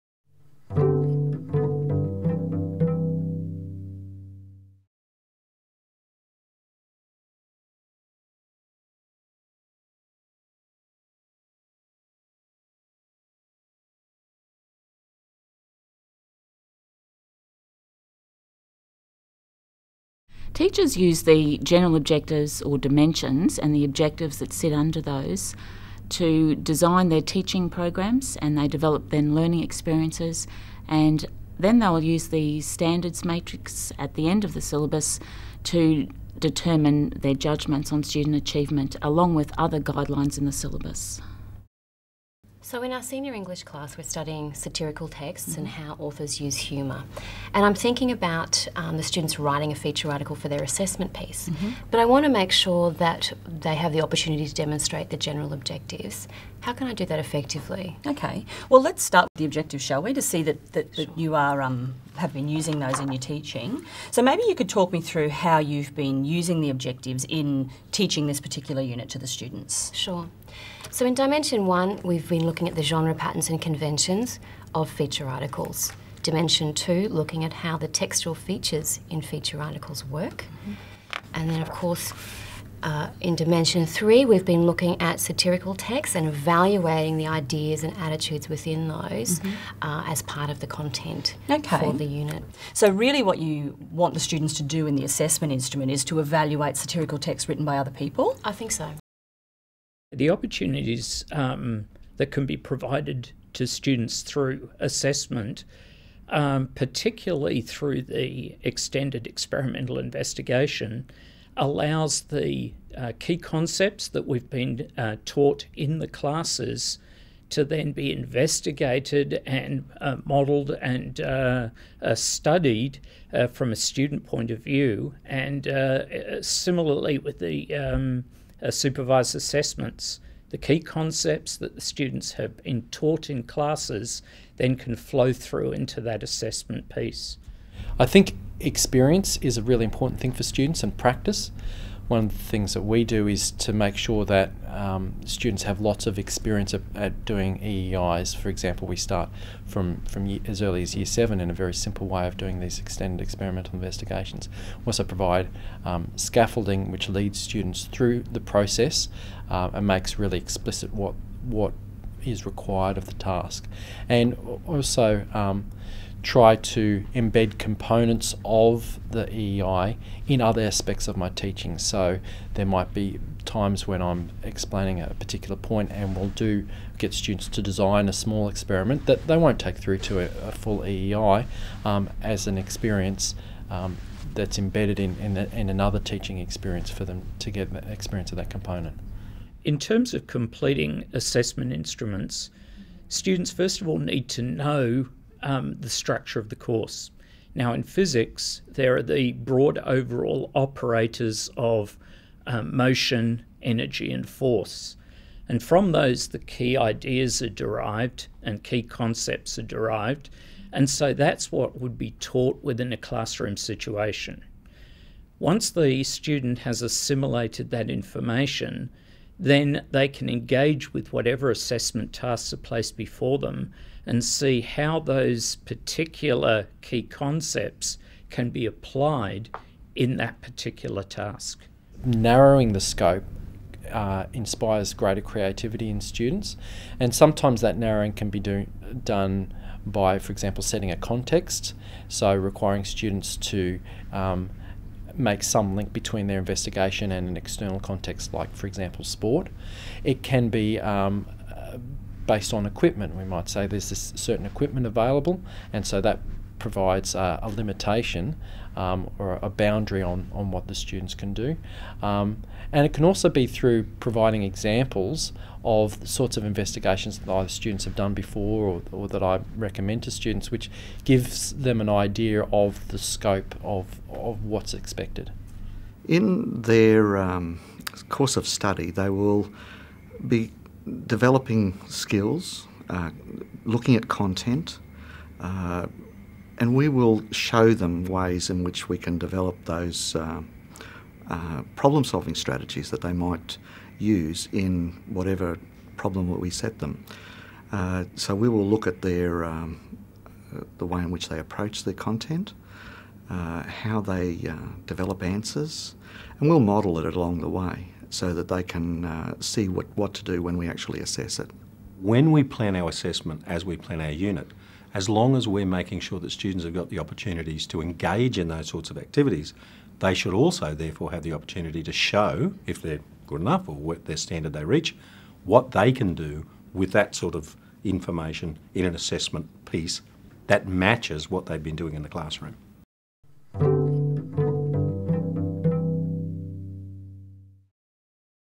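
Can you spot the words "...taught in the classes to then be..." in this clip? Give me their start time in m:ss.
1:55.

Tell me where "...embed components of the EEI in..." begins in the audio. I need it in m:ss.
2:47.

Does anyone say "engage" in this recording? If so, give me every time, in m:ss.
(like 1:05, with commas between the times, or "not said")
3:40, 5:17.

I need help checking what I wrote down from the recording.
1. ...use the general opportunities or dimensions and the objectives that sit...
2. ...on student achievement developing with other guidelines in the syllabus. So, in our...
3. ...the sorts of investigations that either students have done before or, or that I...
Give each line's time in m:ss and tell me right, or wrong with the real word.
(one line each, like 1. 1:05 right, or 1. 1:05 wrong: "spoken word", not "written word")
1. 0:20 wrong: "objectives", not "opportunities"
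2. 0:37 wrong: "along", not "developing"
3. 4:25 right.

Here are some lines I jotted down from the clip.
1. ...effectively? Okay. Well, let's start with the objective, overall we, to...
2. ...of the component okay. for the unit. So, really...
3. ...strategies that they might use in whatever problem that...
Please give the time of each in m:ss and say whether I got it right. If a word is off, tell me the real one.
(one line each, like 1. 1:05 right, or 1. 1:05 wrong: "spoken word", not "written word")
1. 0:57 wrong: "shall", not "overall"
2. 1:30 wrong: "content", not "component"
3. 4:52 right.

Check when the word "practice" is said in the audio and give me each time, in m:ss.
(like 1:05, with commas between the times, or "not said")
2:20.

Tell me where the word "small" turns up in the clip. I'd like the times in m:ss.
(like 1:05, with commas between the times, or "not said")
2:58.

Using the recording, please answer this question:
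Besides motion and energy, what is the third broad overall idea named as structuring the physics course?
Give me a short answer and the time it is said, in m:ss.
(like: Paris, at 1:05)
force, at 3:24.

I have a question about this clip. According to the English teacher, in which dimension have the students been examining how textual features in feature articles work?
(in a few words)
Dimension 2.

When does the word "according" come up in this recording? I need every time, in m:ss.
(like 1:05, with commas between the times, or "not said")
not said.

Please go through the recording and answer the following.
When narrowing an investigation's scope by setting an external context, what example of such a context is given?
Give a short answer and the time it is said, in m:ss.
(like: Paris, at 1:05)
sport, at 4:09.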